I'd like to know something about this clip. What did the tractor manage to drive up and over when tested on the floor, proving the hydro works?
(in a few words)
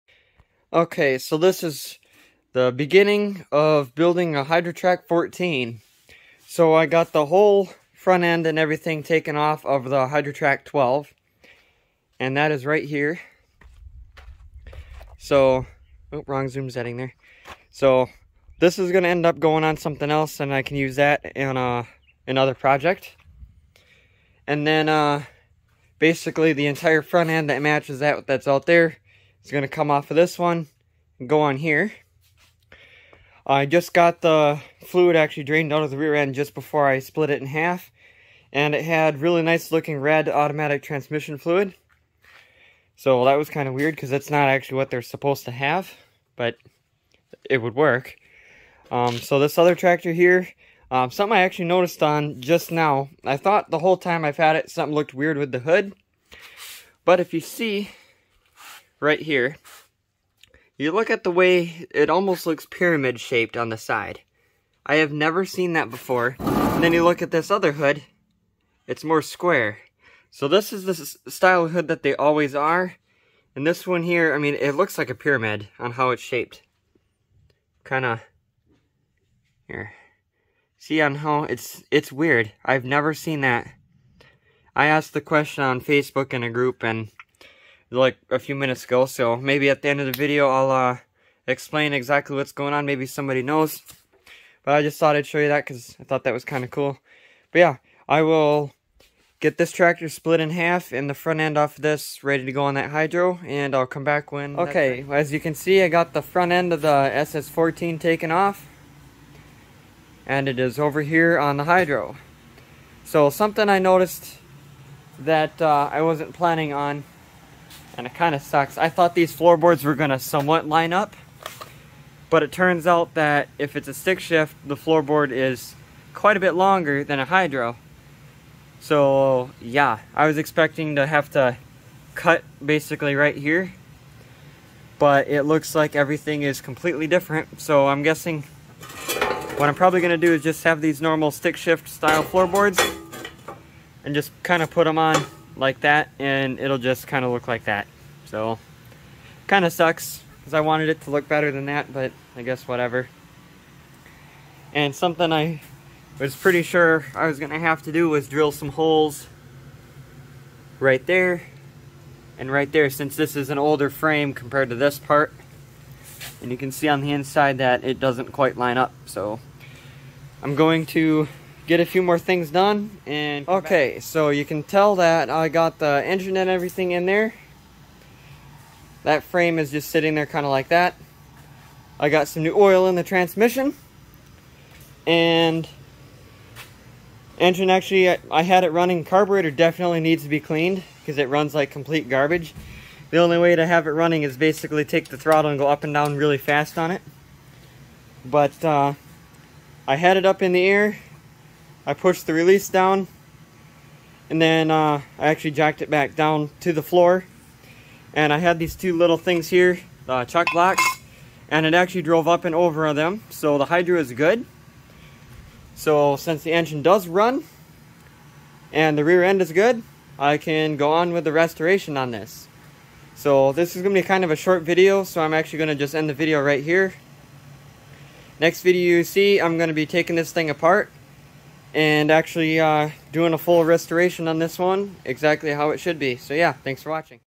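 Chuck blocks.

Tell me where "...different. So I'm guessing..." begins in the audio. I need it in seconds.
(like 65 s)
137 s.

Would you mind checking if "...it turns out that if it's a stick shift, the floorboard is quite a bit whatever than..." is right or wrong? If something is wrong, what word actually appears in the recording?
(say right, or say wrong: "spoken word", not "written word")
wrong: "longer", not "whatever".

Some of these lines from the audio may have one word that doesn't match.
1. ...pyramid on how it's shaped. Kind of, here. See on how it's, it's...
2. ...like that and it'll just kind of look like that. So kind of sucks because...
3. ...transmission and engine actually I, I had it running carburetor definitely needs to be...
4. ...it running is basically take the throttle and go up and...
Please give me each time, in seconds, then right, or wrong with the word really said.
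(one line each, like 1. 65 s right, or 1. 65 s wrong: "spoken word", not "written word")
1. 75 s right
2. 145 s right
3. 183 s right
4. 193 s right.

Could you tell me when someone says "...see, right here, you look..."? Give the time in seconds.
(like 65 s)
57 s.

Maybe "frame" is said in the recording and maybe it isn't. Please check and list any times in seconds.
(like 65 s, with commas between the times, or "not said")
163 s, 179 s.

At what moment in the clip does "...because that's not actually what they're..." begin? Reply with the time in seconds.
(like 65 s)
43 s.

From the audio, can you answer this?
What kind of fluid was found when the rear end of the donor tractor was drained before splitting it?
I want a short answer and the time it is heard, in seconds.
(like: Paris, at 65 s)
Red automatic transmission fluid, at 39 s.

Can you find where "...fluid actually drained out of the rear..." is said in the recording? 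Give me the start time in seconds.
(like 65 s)
34 s.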